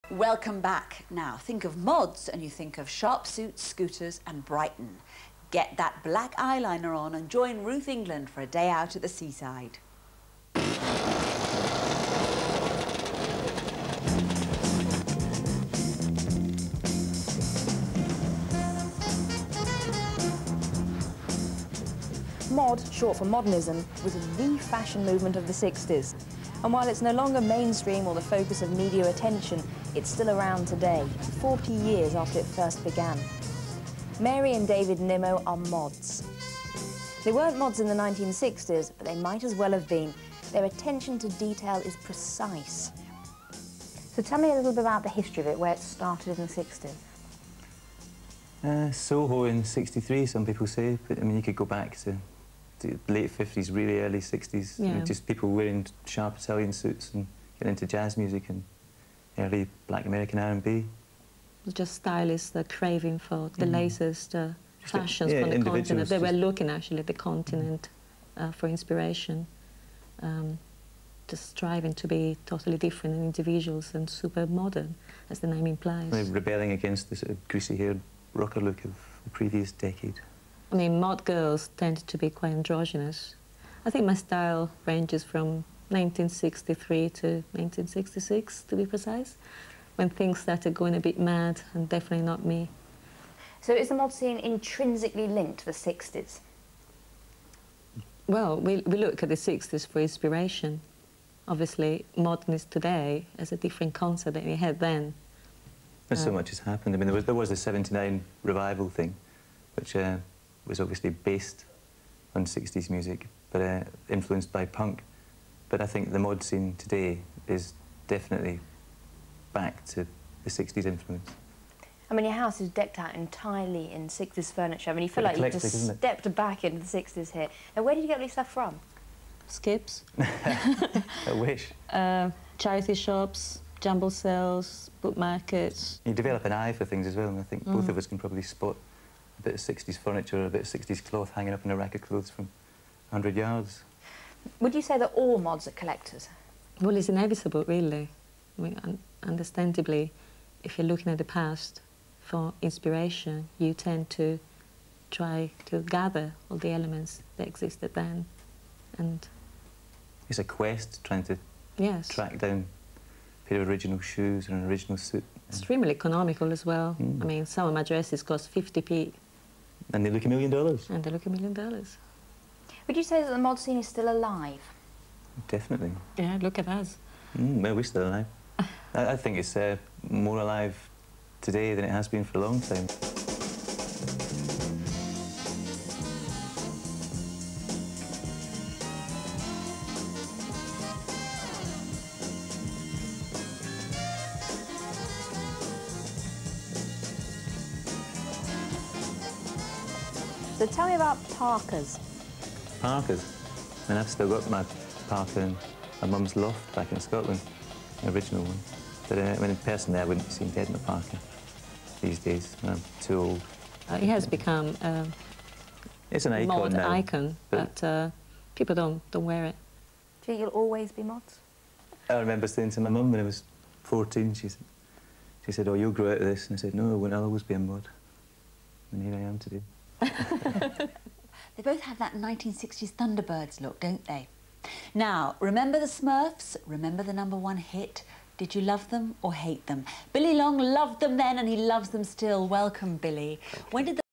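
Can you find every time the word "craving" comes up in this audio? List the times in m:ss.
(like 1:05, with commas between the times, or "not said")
1:02.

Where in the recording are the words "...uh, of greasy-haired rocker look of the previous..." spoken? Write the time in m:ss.
1:17.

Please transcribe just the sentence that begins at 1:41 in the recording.
Obviously, modernists today as a different concept than we had then.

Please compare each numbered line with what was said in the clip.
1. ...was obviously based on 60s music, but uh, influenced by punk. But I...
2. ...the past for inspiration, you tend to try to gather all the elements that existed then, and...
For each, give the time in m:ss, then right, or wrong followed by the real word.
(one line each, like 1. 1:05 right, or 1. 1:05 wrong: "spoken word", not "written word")
1. 1:50 right
2. 2:31 right.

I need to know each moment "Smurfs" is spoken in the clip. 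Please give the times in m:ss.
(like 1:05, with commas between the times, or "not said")
3:55.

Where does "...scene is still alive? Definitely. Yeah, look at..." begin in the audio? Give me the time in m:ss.
2:53.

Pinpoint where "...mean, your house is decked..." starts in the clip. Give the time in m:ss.
2:02.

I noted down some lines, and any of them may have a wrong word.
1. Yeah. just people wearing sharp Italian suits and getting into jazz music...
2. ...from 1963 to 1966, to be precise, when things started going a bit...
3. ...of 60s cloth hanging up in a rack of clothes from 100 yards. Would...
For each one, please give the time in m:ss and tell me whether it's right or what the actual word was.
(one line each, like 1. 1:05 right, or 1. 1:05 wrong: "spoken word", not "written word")
1. 0:54 right
2. 1:25 right
3. 2:20 right.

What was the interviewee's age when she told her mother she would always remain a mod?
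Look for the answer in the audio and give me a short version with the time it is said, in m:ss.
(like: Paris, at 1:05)
14, at 3:43.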